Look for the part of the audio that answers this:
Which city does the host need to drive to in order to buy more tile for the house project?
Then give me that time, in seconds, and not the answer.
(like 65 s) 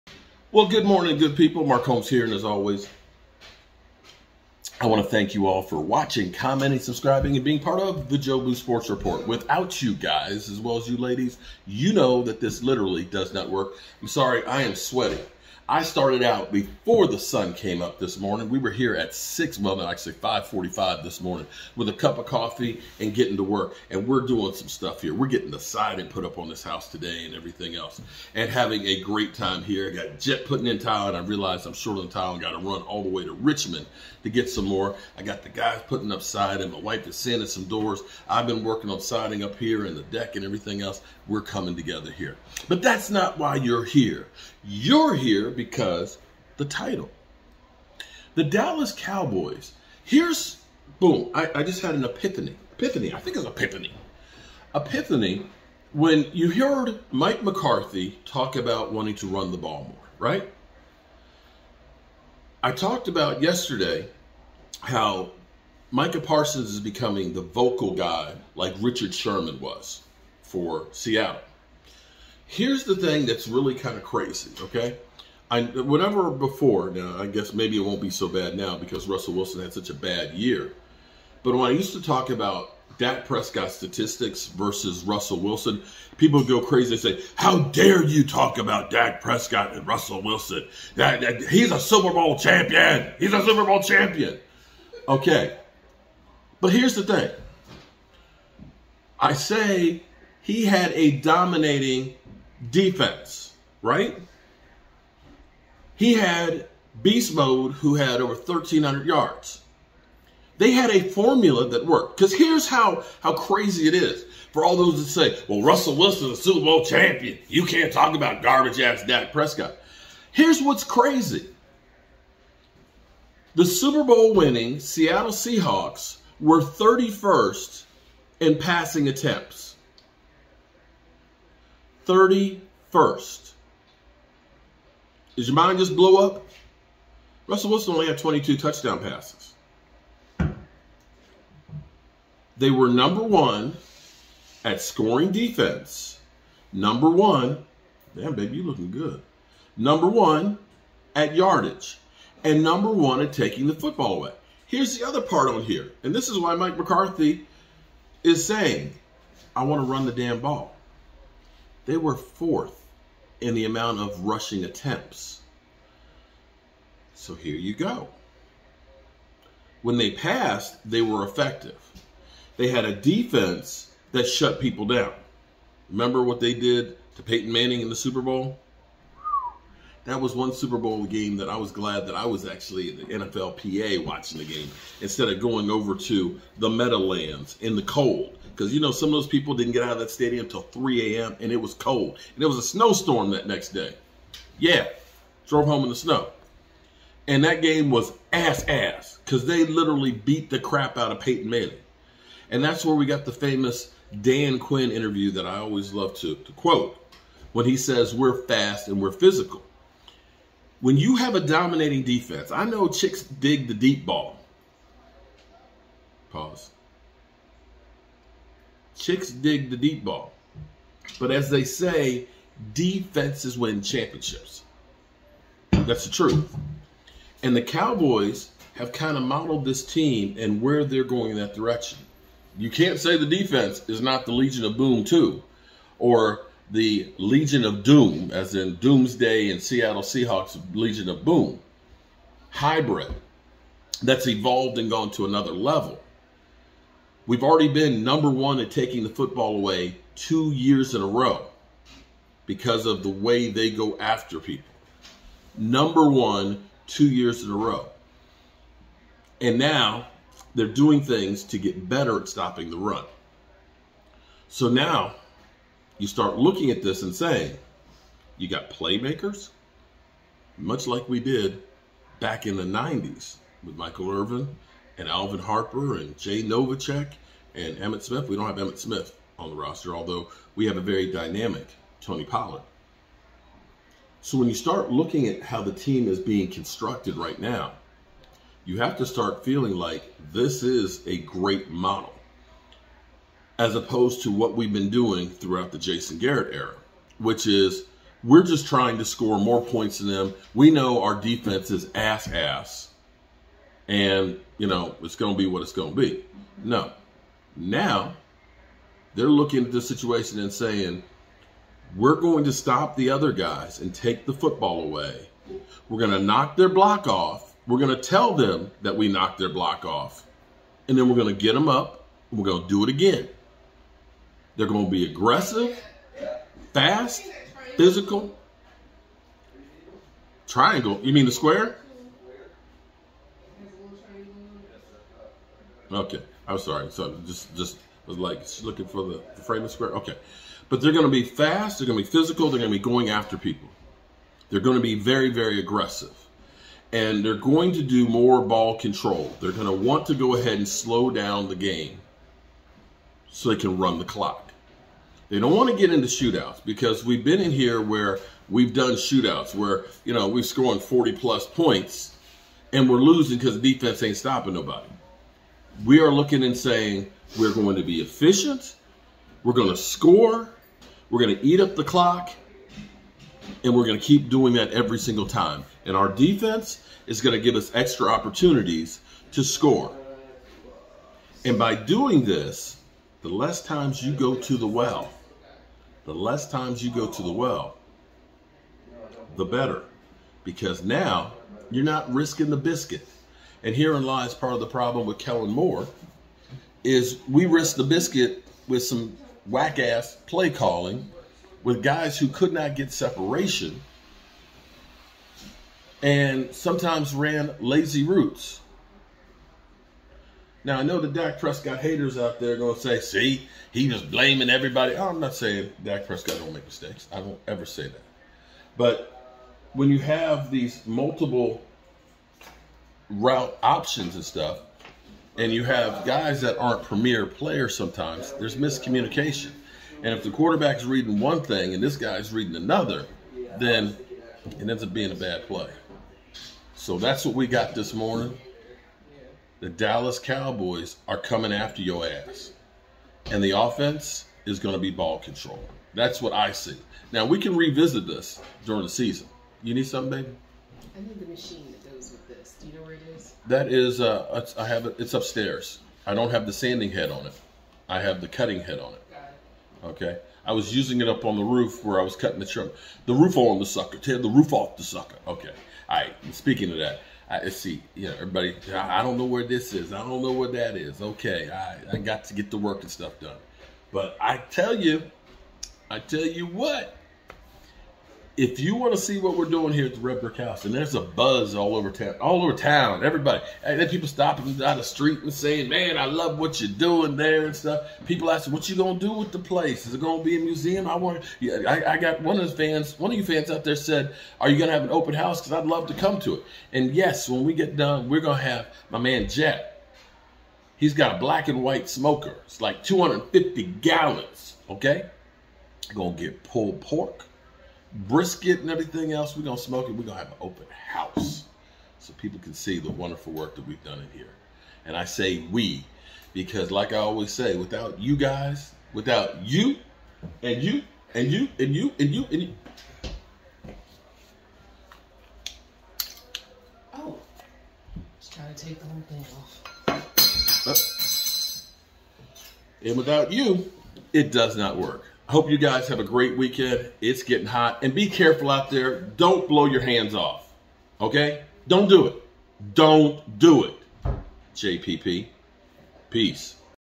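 33 s.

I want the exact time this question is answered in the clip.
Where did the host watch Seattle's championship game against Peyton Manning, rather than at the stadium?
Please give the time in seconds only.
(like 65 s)
183 s.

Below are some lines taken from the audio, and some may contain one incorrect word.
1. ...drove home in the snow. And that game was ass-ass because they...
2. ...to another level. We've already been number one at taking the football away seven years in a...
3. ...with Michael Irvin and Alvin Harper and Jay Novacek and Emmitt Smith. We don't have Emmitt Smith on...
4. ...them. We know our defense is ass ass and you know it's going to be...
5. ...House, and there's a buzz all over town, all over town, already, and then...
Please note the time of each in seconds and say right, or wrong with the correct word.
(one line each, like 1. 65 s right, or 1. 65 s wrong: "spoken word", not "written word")
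1. 195 s right
2. 245 s wrong: "two", not "seven"
3. 273 s right
4. 300 s right
5. 480 s wrong: "everybody", not "already".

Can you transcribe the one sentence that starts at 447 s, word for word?
Now, we can revisit this during the season.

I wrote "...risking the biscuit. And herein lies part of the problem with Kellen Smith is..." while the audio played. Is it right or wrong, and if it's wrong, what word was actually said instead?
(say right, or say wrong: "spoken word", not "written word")
wrong: "Moore", not "Smith".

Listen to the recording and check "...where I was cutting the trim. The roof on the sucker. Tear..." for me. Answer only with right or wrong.
right.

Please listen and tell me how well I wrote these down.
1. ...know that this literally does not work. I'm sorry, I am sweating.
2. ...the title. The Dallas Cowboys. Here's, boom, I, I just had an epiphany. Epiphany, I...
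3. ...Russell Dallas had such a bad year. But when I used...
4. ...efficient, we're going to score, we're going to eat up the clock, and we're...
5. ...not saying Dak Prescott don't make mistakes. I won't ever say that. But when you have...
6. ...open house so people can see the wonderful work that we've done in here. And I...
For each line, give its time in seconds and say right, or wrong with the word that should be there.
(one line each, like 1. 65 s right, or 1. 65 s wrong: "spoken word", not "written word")
1. 11 s right
2. 46 s right
3. 79 s wrong: "Wilson", not "Dallas"
4. 368 s right
5. 415 s right
6. 510 s right.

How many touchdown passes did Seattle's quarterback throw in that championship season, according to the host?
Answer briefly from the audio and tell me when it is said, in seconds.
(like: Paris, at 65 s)
22, at 138 s.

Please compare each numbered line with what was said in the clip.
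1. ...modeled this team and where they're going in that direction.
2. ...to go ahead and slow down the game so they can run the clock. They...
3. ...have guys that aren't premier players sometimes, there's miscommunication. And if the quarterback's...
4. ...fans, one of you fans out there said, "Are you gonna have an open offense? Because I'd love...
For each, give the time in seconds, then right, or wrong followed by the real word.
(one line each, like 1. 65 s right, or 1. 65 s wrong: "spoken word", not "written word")
1. 229 s right
2. 350 s right
3. 425 s right
4. 492 s wrong: "house", not "offense".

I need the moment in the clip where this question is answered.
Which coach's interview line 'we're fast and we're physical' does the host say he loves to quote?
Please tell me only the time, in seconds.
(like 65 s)
204 s.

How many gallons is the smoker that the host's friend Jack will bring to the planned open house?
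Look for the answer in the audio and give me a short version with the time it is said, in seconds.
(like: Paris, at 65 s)
250, at 502 s.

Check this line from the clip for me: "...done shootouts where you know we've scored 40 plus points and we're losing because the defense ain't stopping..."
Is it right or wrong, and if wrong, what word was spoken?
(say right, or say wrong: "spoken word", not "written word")
right.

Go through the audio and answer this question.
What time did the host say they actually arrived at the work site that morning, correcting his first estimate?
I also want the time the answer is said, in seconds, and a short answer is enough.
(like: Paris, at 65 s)
5:45, at 20 s.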